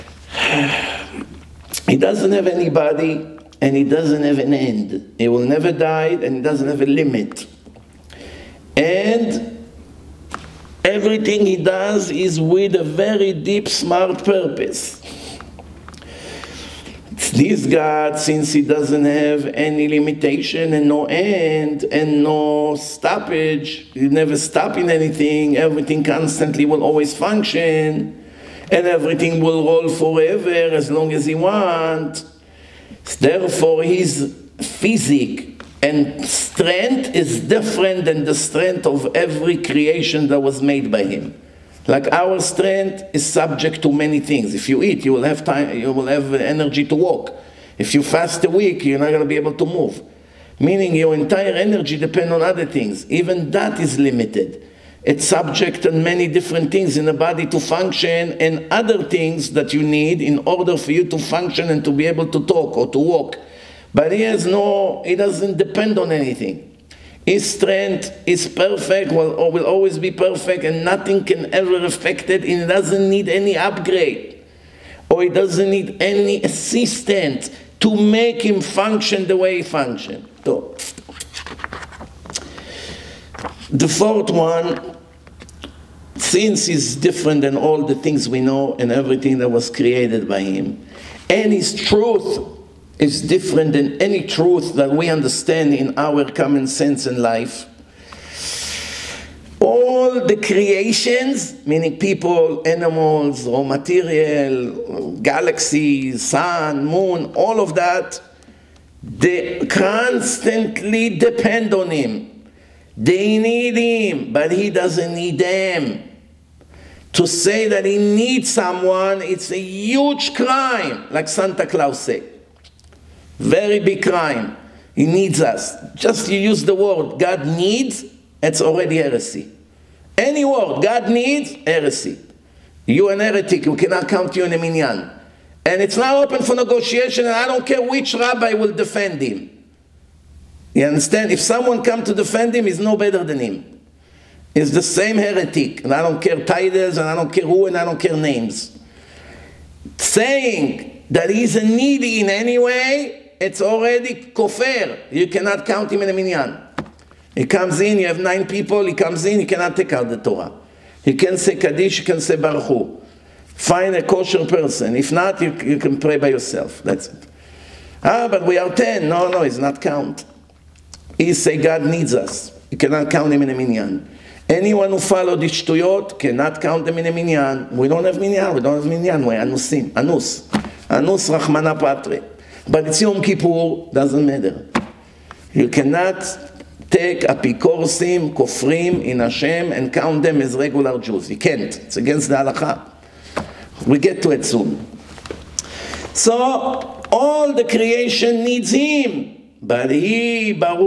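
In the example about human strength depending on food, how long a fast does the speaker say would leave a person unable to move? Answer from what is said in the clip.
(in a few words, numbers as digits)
a week.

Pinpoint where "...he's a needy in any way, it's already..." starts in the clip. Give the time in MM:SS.
02:31.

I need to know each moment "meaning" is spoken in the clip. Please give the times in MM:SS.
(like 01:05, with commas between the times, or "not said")
00:50, 01:41.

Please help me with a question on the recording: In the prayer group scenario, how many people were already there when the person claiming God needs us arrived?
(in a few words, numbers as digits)
9.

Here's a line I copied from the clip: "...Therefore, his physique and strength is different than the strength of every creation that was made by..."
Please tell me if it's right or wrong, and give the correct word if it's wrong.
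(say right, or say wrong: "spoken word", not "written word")
right.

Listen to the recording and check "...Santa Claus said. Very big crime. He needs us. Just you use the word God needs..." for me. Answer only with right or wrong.
right.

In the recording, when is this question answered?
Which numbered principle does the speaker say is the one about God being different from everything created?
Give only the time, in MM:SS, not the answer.
01:23.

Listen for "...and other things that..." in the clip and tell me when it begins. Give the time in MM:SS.
00:58.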